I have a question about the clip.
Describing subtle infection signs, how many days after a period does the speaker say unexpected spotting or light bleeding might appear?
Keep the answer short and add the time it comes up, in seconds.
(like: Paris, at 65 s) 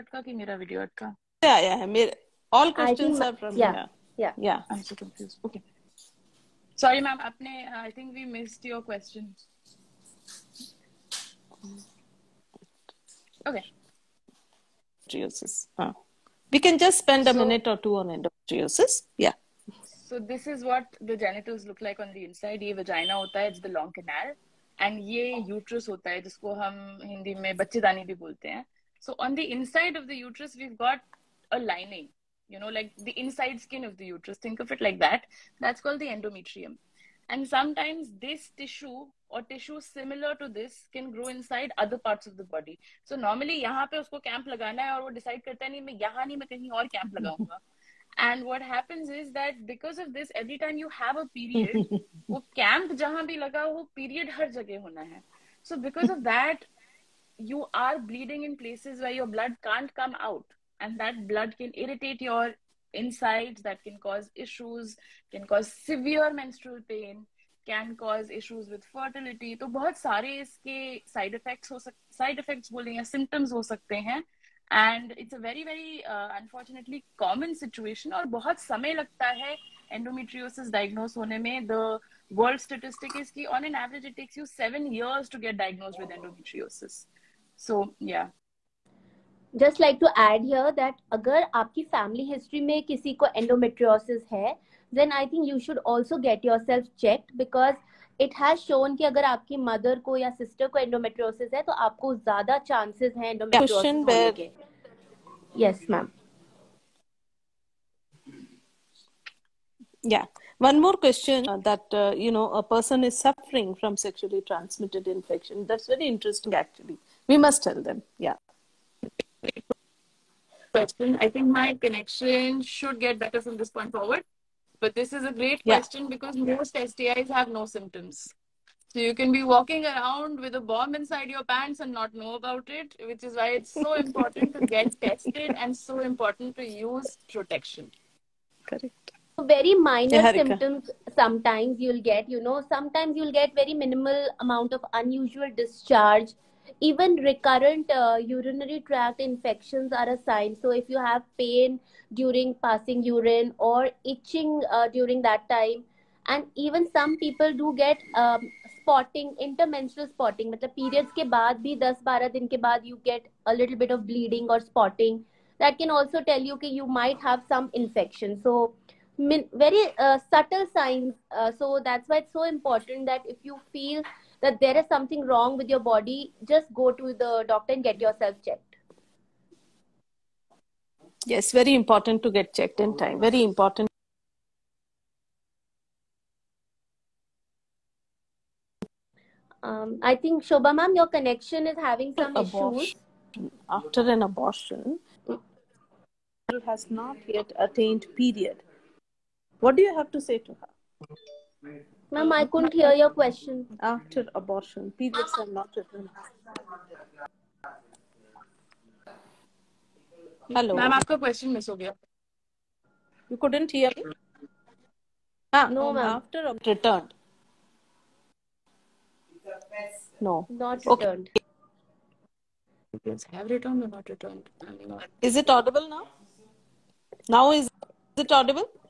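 10-12 days, at 161 s.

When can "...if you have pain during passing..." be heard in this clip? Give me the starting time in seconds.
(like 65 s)
150 s.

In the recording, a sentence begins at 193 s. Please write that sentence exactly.
After an abortion, has not yet attained period.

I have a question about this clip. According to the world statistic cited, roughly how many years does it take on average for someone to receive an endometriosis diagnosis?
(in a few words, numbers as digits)
7 years.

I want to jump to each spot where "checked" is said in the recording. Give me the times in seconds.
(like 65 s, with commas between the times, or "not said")
178 s, 182 s.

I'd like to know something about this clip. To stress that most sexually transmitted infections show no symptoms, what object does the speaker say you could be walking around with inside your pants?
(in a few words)
a bomb.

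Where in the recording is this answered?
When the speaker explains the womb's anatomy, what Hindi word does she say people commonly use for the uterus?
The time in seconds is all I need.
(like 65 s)
27 s.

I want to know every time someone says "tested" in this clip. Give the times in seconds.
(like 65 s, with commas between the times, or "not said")
135 s.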